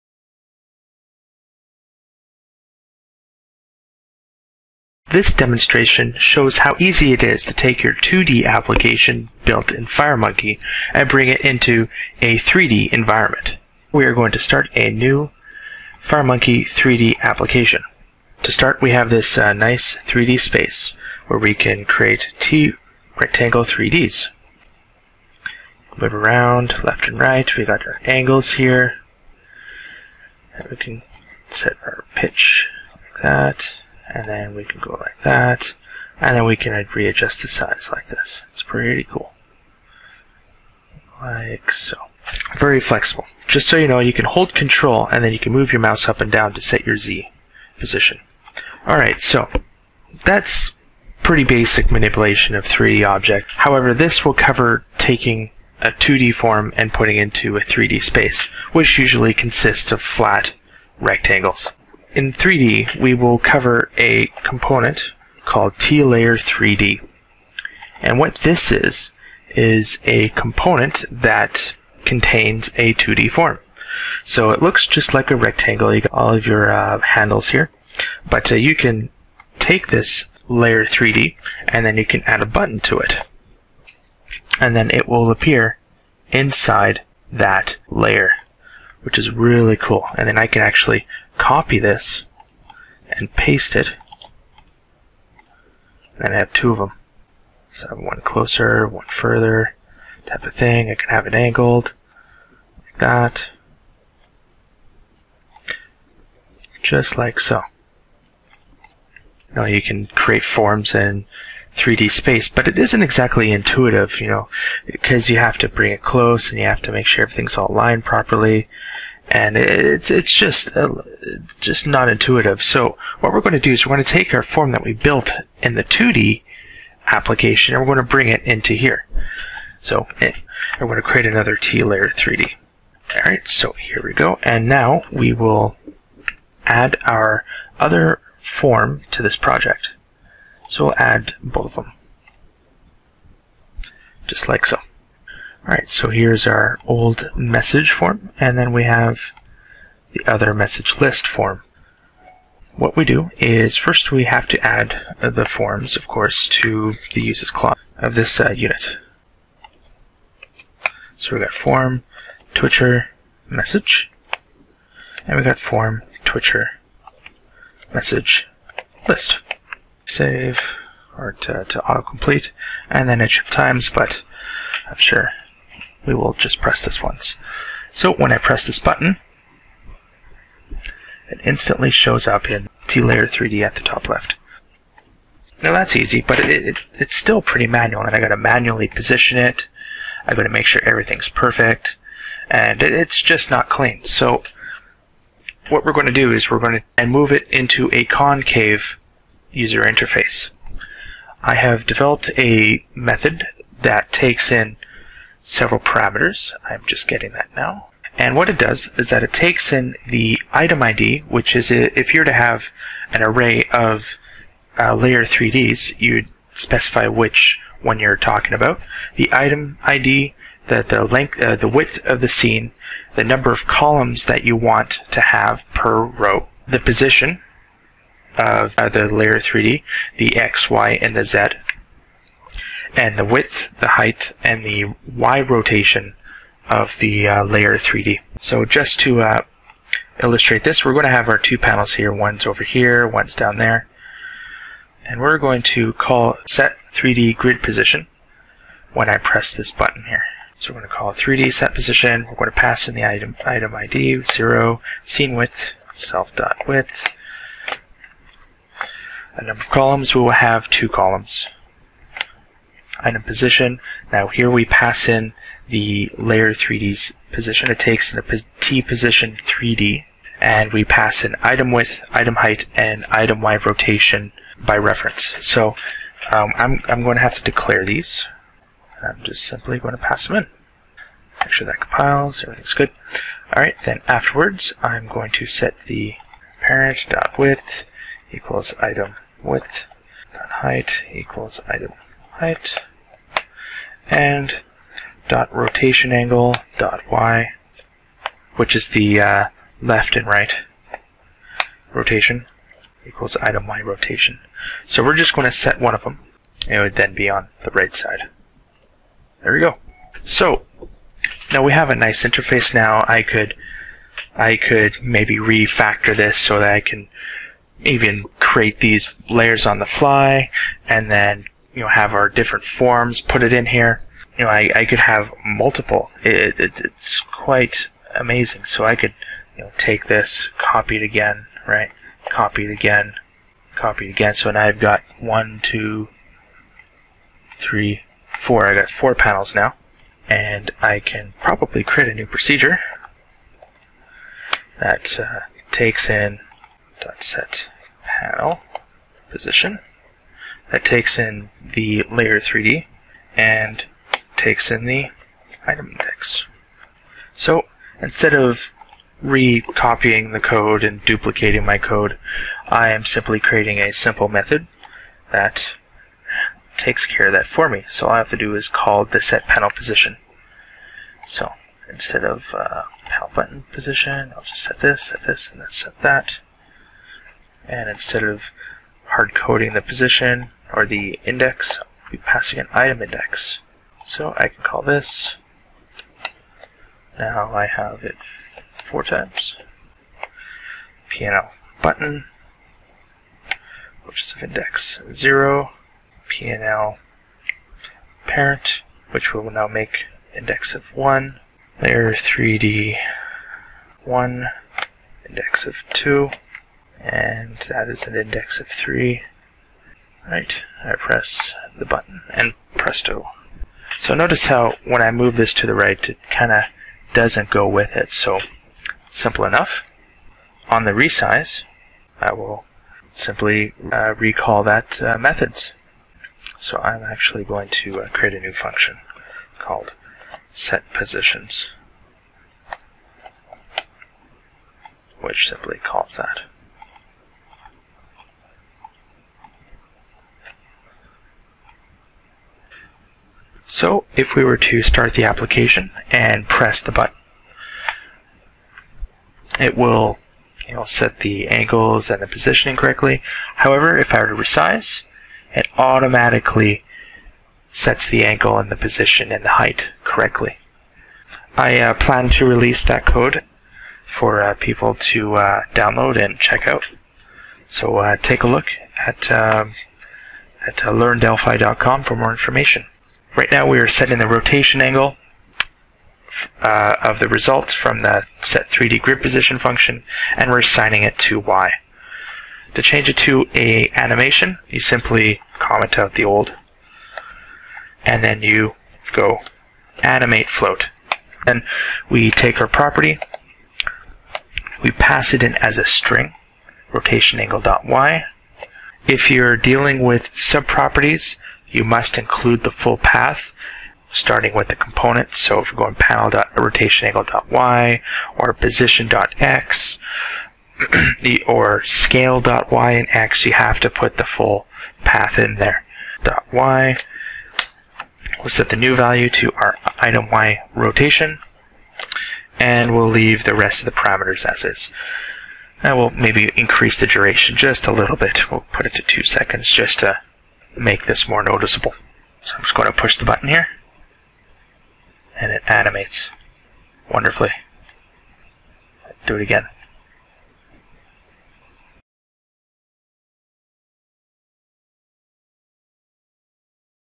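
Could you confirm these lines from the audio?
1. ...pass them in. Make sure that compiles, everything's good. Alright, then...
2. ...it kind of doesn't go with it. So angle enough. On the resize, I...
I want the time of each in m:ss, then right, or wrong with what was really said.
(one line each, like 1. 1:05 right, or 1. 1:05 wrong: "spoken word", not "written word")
1. 4:40 right
2. 6:56 wrong: "simple", not "angle".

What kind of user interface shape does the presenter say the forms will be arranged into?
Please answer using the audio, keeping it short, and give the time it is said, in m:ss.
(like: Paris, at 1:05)
Concave, at 3:18.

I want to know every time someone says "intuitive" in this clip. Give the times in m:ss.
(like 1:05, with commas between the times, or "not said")
1:53, 2:02.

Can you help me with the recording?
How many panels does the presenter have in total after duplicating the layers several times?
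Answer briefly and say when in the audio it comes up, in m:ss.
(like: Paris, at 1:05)
4, at 5:38.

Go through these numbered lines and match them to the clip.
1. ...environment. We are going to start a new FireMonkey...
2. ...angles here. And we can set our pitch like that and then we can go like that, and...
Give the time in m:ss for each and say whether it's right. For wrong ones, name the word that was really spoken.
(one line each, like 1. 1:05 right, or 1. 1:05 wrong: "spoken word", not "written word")
1. 0:12 right
2. 0:28 right.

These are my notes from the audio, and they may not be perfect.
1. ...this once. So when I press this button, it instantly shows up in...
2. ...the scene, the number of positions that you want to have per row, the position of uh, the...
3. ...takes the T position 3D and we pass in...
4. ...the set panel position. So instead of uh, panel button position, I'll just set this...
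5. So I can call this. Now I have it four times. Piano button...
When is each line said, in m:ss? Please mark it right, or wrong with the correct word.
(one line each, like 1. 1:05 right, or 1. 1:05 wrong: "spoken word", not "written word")
1. 2:56 right
2. 3:42 wrong: "columns", not "positions"
3. 4:27 right
4. 6:09 right
5. 6:24 right.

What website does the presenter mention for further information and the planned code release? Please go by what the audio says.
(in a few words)
learndelphi.com.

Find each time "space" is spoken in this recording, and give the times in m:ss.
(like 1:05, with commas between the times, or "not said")
0:20, 0:58, 1:52.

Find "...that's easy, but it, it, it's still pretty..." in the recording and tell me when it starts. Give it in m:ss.
3:05.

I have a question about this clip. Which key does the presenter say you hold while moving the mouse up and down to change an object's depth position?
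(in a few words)
Control.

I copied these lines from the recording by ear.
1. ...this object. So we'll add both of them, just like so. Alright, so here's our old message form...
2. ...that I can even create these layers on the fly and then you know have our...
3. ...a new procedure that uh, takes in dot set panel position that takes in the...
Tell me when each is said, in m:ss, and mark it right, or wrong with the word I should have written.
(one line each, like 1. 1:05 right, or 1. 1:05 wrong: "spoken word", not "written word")
1. 2:19 wrong: "project", not "object"
2. 5:16 right
3. 5:42 right.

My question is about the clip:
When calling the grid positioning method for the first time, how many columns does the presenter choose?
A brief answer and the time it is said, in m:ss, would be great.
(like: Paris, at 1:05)
2, at 4:20.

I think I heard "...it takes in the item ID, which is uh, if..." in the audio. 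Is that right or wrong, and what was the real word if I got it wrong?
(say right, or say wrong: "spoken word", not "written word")
right.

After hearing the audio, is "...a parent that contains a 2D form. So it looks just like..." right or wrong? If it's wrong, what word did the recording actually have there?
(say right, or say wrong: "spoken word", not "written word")
wrong: "component", not "parent".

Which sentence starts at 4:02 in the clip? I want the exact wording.
One's over here, one's down there.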